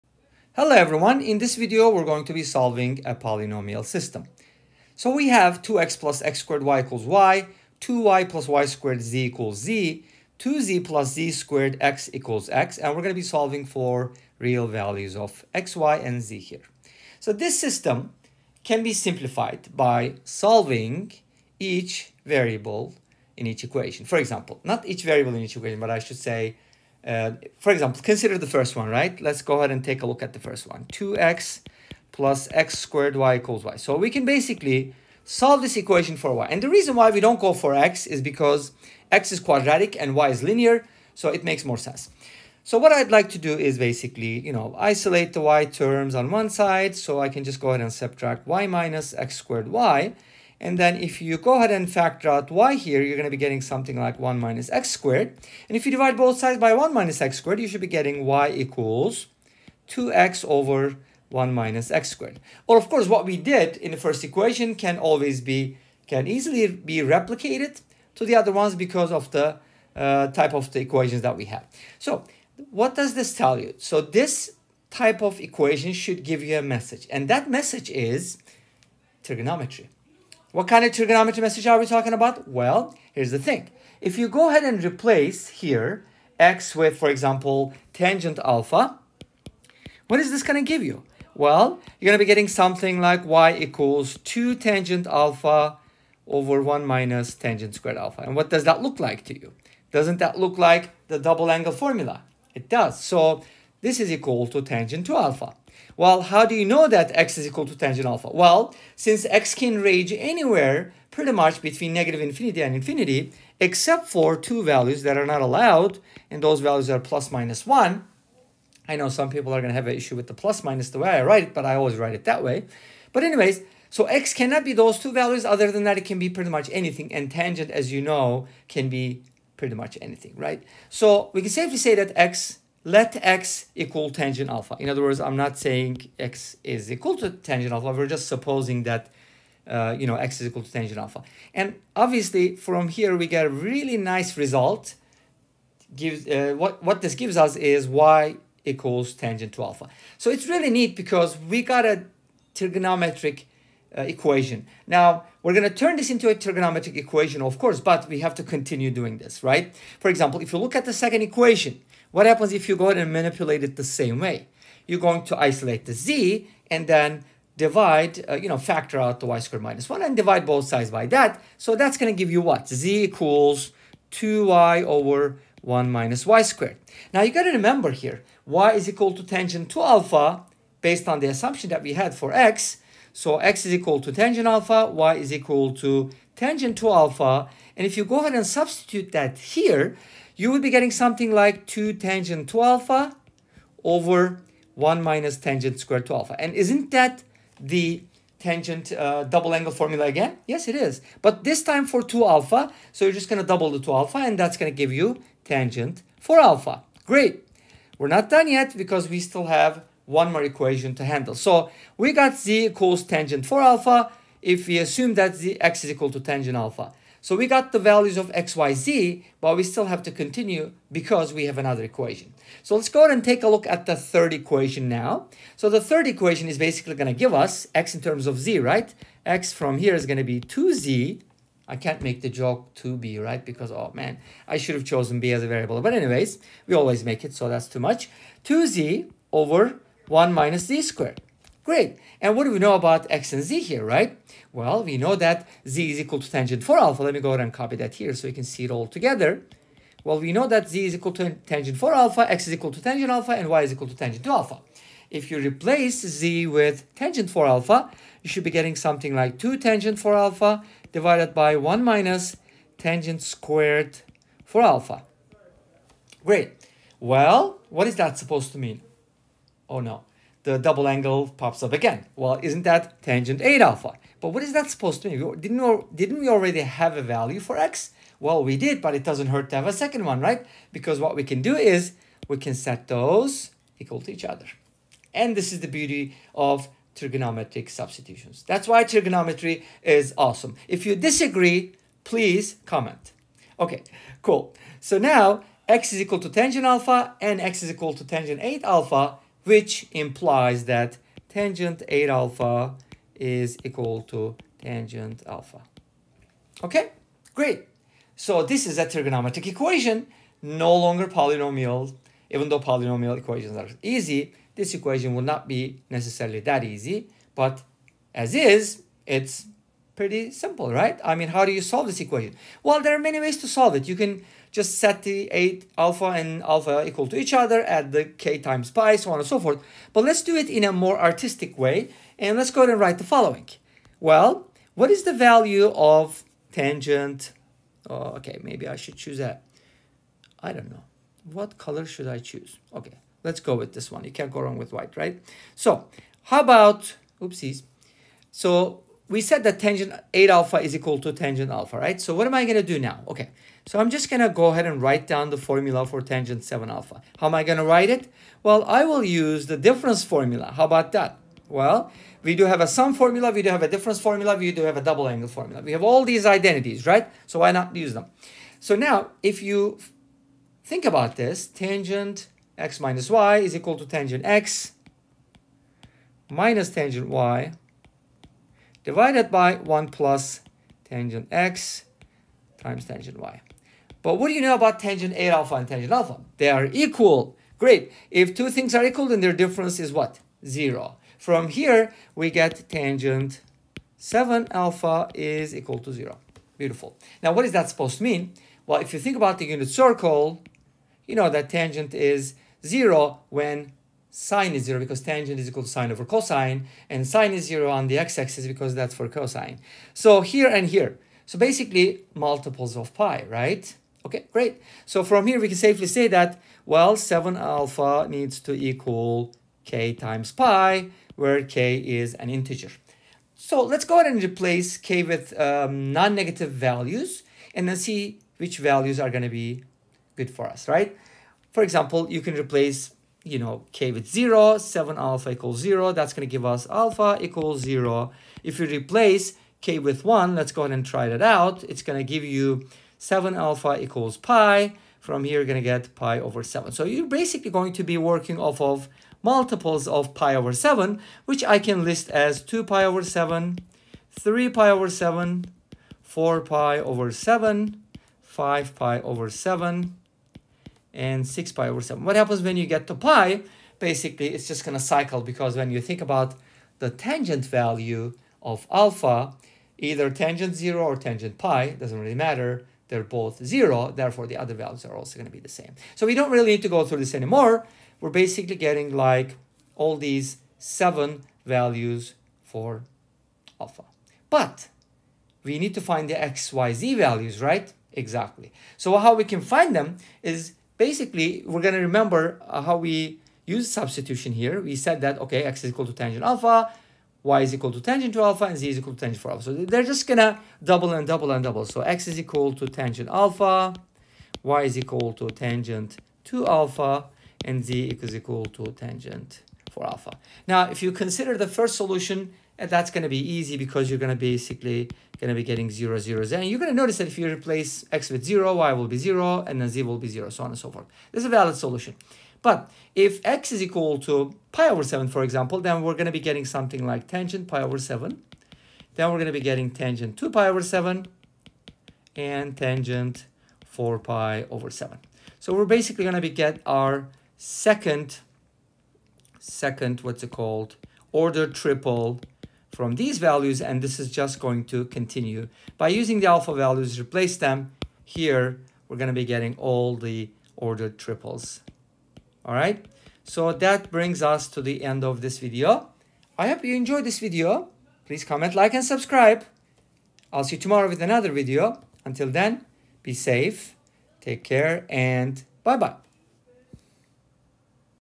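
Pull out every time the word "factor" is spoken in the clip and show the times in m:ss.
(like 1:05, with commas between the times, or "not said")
0:51, 2:48.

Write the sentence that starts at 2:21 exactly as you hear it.
And obviously, from here, we get a really nice result.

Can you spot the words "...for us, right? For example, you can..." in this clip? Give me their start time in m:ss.
7:10.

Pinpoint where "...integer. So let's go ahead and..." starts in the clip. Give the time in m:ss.
7:02.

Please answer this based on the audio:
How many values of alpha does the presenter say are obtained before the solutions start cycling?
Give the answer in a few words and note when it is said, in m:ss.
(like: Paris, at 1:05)
7, at 8:00.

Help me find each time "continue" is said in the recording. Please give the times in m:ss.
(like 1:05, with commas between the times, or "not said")
2:38, 3:40, 9:04.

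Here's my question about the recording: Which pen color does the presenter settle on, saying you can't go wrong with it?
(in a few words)
white.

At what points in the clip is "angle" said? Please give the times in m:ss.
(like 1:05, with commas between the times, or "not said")
1:41, 3:19, 4:30, 6:05.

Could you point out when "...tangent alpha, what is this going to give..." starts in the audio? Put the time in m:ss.
1:27.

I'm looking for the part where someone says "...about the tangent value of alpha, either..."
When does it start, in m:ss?
7:46.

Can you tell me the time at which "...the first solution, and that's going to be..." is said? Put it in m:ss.
8:31.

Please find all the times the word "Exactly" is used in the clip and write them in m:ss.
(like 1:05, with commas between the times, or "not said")
8:07.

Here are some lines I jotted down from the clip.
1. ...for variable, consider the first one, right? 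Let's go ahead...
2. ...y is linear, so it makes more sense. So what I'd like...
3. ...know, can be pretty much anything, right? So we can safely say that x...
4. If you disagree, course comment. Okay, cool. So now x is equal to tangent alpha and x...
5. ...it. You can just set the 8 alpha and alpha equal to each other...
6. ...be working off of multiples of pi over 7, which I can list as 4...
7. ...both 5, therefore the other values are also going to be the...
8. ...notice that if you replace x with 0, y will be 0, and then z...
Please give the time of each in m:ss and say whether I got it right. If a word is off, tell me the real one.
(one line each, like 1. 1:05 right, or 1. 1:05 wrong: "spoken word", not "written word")
1. 0:27 wrong: "example", not "variable"
2. 0:40 right
3. 2:08 right
4. 4:50 wrong: "please", not "course"
5. 5:23 right
6. 7:27 wrong: "2", not "4"
7. 7:53 wrong: "0", not "5"
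8. 8:36 right.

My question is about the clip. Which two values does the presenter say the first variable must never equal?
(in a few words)
plus minus 1.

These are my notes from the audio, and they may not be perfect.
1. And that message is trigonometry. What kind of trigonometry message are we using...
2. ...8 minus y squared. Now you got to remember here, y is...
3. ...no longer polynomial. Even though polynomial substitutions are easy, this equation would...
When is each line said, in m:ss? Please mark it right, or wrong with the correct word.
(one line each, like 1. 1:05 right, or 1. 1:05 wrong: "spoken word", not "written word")
1. 1:17 wrong: "talking", not "using"
2. 2:55 wrong: "1", not "8"
3. 5:10 wrong: "equations", not "substitutions".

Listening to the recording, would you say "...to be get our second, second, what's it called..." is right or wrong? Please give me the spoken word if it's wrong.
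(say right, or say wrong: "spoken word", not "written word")
right.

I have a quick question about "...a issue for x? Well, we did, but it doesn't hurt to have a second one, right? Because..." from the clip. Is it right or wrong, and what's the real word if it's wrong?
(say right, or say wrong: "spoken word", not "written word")
wrong: "value", not "issue".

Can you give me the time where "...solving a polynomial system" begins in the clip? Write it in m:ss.
0:02.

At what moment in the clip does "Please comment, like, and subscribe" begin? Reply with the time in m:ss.
9:18.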